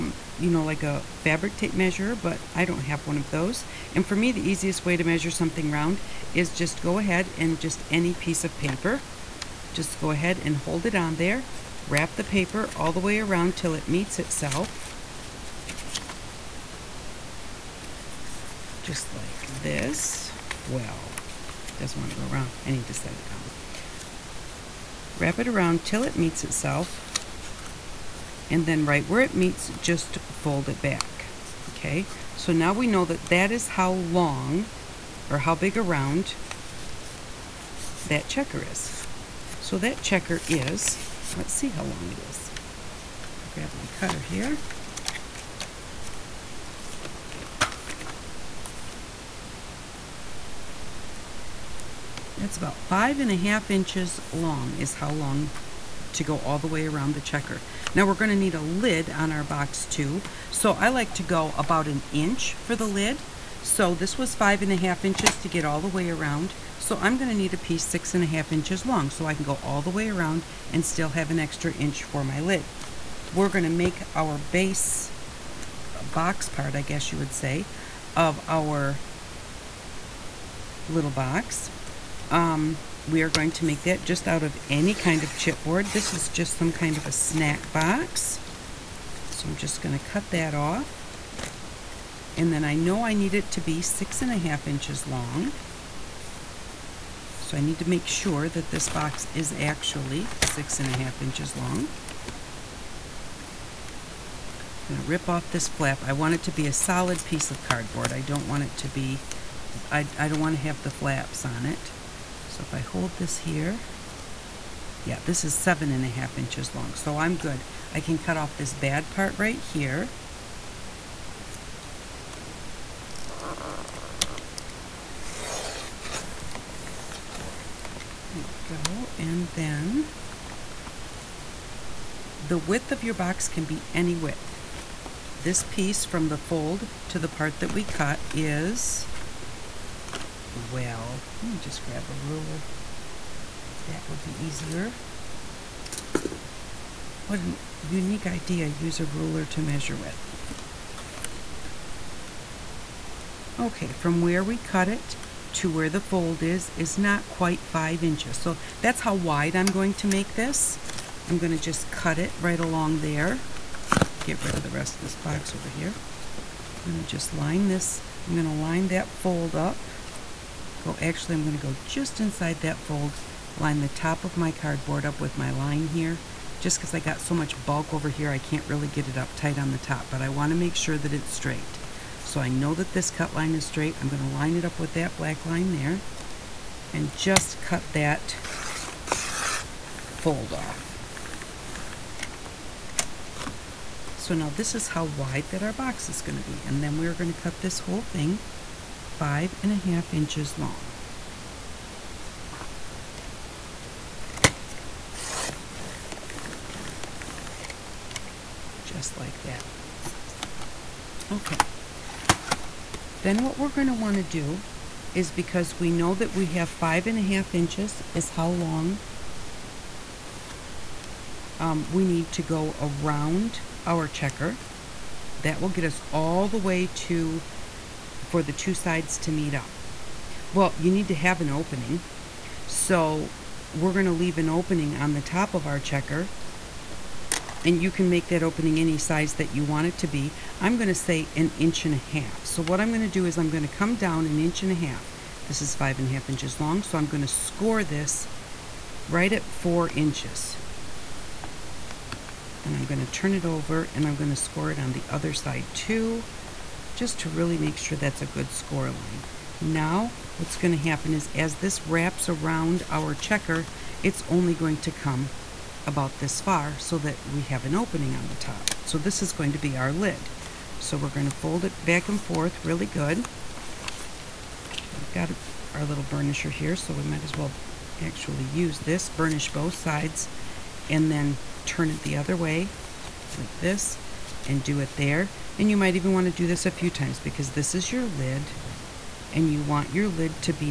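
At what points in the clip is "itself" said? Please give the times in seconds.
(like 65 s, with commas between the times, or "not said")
14 s, 26 s.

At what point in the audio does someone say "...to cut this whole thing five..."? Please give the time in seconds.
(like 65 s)
197 s.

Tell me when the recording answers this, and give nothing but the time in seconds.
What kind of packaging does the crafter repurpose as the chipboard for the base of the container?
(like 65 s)
87 s.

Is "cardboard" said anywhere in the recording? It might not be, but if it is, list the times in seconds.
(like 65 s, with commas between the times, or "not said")
107 s, 174 s.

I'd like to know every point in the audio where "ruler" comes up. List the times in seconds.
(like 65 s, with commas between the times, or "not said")
142 s, 149 s.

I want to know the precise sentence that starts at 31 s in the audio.
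Okay, so now we know that that is how long or how big around that checker is.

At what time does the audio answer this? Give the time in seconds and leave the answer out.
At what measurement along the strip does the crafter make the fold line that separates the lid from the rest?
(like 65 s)
249 s.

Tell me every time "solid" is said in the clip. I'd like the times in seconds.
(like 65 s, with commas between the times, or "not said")
106 s.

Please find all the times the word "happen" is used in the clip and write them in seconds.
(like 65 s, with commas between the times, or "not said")
260 s.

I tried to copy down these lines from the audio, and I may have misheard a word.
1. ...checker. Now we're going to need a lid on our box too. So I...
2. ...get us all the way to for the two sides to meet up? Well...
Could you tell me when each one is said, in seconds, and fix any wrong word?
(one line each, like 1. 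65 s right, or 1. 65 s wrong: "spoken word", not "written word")
1. 57 s right
2. 225 s right.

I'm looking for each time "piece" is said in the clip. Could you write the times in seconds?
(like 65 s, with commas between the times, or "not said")
8 s, 67 s, 107 s, 135 s.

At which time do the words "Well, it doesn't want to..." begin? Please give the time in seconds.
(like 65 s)
20 s.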